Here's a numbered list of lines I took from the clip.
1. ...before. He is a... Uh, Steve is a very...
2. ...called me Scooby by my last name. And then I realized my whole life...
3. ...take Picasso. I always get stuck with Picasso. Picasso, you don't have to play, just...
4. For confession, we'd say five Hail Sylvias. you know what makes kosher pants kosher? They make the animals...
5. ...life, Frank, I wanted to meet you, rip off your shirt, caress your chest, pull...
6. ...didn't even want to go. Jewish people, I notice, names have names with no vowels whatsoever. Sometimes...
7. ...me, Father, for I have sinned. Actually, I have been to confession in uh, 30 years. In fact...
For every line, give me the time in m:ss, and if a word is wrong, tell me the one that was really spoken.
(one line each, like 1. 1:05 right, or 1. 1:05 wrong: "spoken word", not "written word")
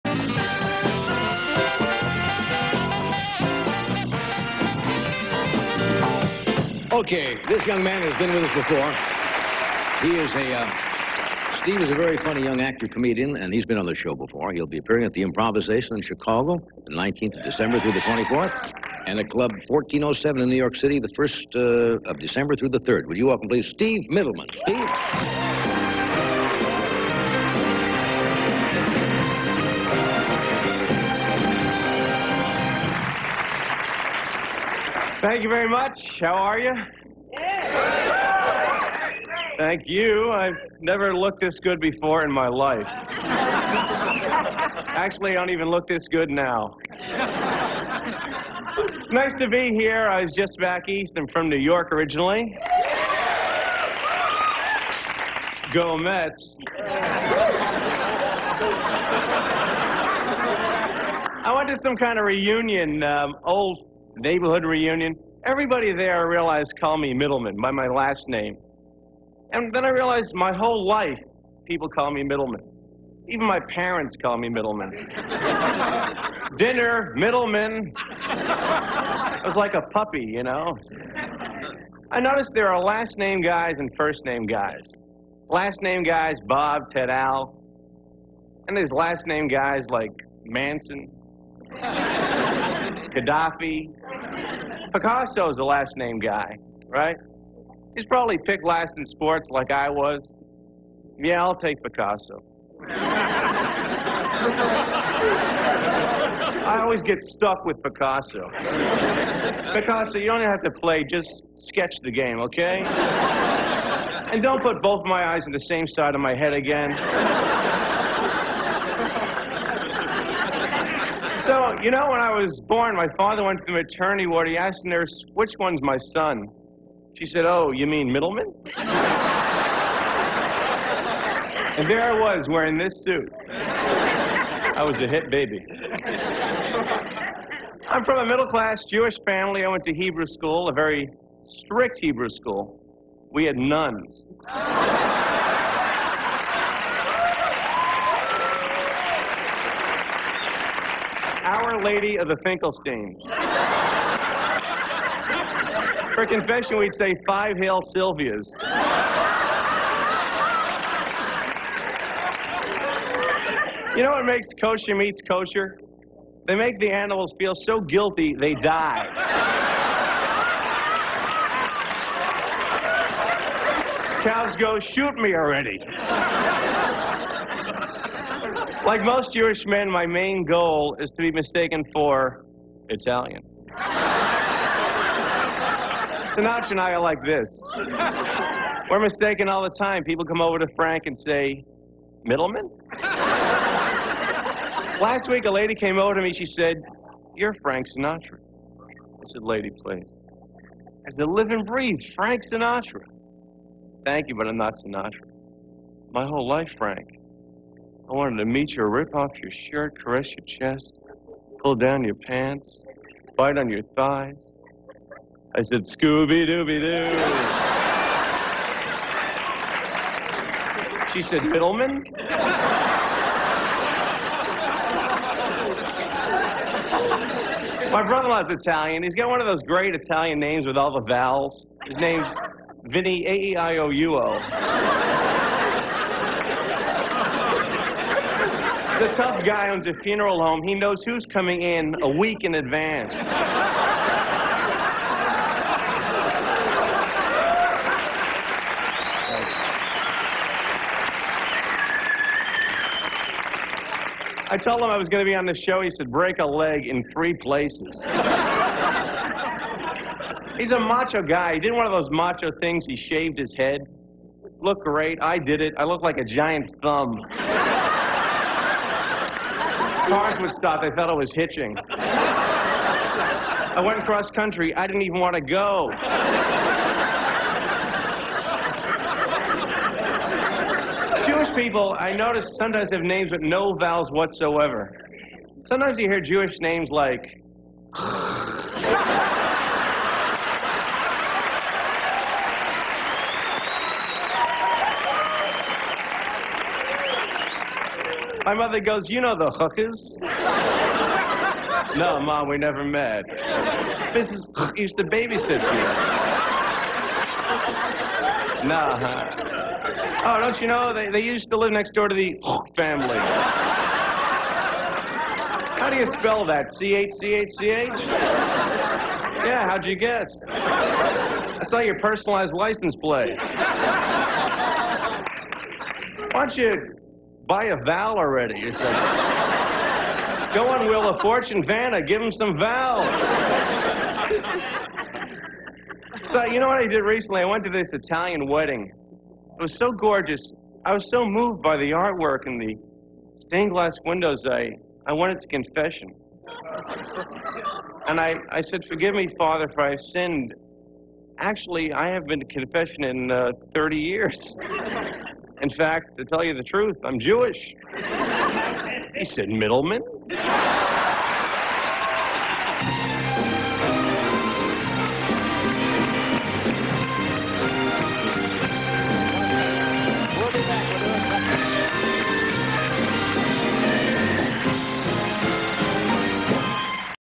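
1. 0:08 right
2. 1:06 wrong: "Mittleman", not "Scooby"
3. 1:41 right
4. 2:36 wrong: "meats", not "pants"
5. 3:26 right
6. 4:34 wrong: "sometimes", not "names"
7. 5:49 right.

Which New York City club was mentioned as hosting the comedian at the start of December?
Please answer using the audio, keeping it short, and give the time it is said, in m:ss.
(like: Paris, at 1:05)
Club 1407, at 0:19.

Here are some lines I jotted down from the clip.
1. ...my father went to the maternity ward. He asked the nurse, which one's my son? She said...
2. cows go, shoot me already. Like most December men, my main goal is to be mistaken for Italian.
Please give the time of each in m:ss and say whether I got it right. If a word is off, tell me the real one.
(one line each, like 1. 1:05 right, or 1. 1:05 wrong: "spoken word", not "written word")
1. 2:02 right
2. 2:54 wrong: "Jewish", not "December".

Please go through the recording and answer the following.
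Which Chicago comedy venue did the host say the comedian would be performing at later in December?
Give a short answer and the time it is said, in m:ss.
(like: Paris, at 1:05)
Improvisation, at 0:15.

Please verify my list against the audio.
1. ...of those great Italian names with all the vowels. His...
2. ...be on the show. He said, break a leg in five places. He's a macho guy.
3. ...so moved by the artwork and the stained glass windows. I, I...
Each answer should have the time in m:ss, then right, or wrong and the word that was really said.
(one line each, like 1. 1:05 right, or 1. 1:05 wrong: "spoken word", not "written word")
1. 3:49 right
2. 4:15 wrong: "three", not "five"
3. 5:41 right.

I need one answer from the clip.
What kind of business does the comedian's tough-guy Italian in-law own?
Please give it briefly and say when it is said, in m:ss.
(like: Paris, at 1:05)
funeral home, at 4:00.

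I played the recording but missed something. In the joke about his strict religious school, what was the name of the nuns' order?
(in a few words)
Our Lady of the Finkelsteins.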